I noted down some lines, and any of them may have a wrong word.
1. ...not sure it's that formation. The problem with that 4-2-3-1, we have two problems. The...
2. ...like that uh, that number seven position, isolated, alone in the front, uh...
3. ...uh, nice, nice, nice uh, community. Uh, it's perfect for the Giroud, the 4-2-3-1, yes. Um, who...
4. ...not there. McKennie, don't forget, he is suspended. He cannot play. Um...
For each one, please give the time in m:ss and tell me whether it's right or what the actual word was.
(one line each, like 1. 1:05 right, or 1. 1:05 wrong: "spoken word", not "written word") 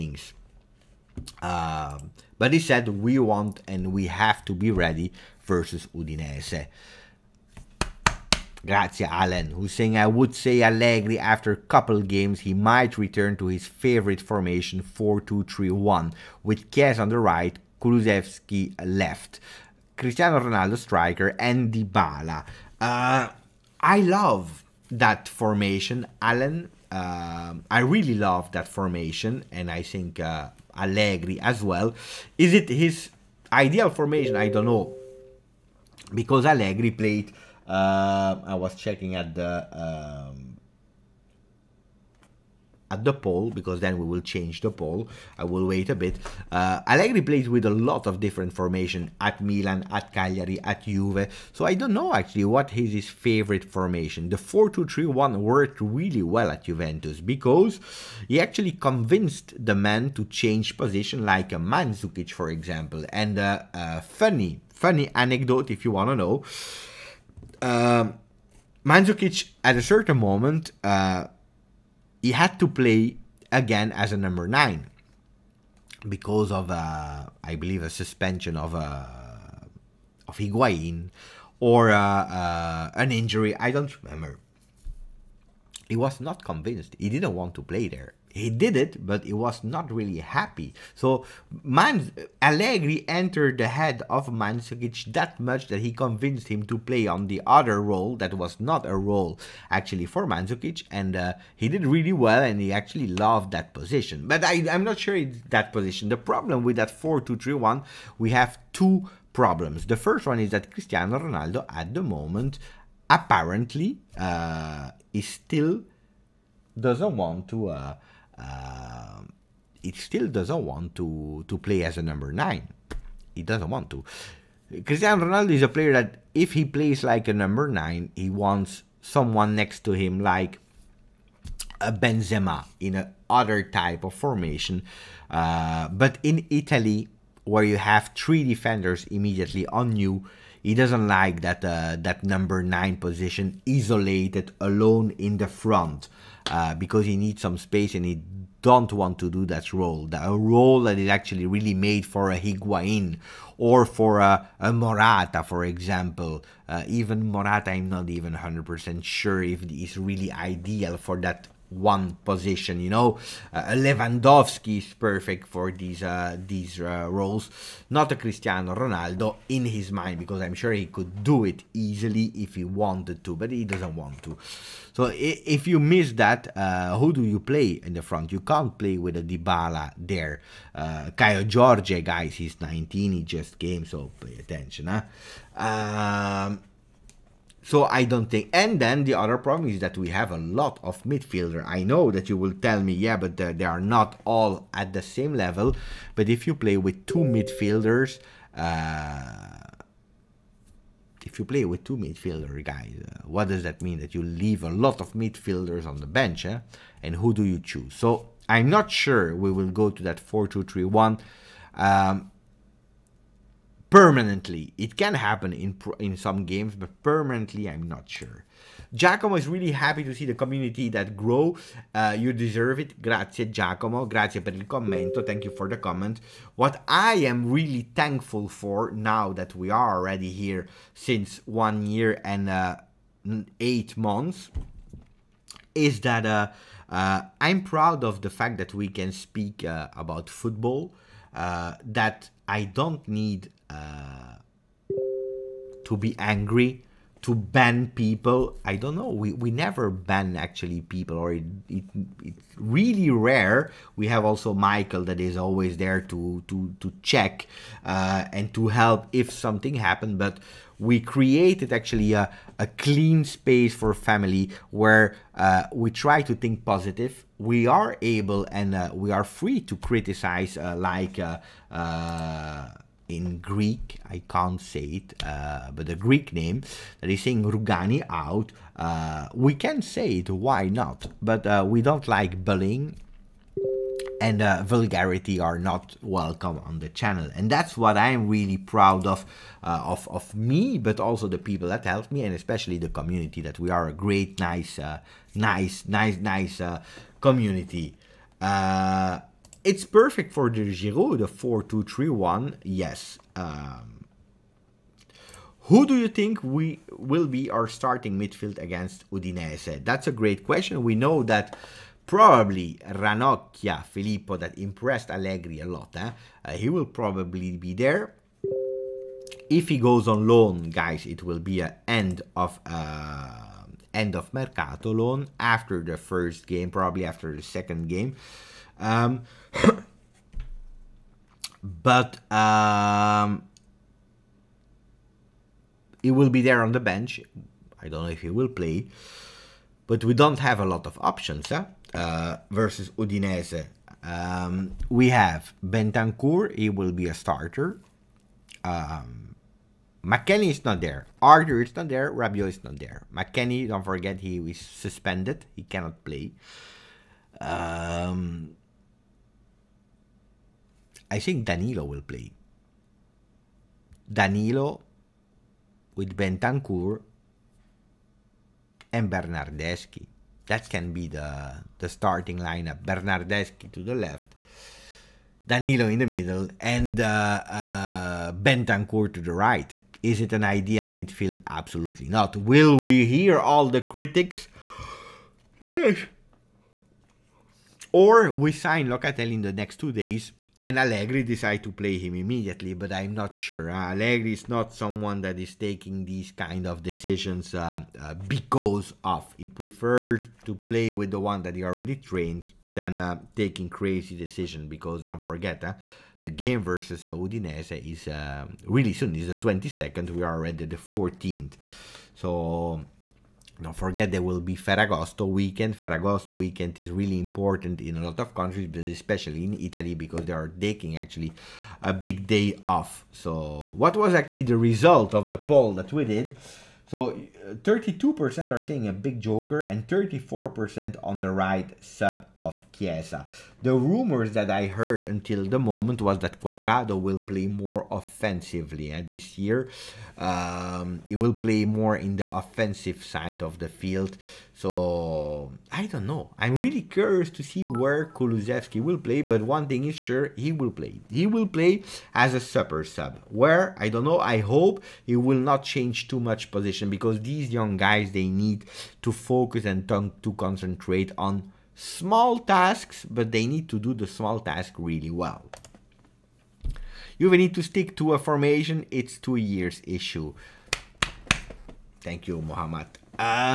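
1. 1:44 wrong: "position", not "formation"
2. 2:21 wrong: "nine", not "seven"
3. 4:54 right
4. 5:52 right.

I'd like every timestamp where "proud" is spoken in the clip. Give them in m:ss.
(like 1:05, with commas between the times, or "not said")
3:57, 4:48.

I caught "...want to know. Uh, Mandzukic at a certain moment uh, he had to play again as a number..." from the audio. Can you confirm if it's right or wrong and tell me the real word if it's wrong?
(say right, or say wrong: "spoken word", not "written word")
right.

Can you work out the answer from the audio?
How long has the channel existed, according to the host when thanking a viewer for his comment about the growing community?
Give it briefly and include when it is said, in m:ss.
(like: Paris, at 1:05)
1 year and 8 months, at 3:51.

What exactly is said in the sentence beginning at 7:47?
You will need to stick to a formation.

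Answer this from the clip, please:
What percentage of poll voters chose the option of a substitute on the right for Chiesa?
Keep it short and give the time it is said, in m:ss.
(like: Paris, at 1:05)
34%, at 7:09.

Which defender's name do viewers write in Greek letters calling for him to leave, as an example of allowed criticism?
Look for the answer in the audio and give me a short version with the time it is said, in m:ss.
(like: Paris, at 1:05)
Rugani, at 4:37.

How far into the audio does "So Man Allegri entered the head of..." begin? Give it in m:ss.
1:30.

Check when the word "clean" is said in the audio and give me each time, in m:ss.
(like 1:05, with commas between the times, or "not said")
4:22.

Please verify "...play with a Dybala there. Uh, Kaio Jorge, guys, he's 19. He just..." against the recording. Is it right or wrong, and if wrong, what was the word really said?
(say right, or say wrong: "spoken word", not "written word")
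right.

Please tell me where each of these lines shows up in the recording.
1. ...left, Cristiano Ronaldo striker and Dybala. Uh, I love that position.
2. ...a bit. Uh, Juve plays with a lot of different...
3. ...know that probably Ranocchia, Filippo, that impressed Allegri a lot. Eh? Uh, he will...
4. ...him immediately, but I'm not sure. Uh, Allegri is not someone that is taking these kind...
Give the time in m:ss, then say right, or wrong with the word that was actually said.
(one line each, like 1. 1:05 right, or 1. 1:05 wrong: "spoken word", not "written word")
1. 0:18 wrong: "formation", not "position"
2. 0:45 wrong: "Allegri", not "Juve"
3. 5:10 right
4. 6:31 right.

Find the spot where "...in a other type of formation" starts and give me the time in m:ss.
2:12.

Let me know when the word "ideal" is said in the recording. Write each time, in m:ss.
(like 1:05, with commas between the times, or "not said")
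0:33, 2:40, 6:20.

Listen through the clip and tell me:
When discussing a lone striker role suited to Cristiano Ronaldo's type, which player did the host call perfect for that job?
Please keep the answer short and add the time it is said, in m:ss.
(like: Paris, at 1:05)
Lewandowski, at 2:43.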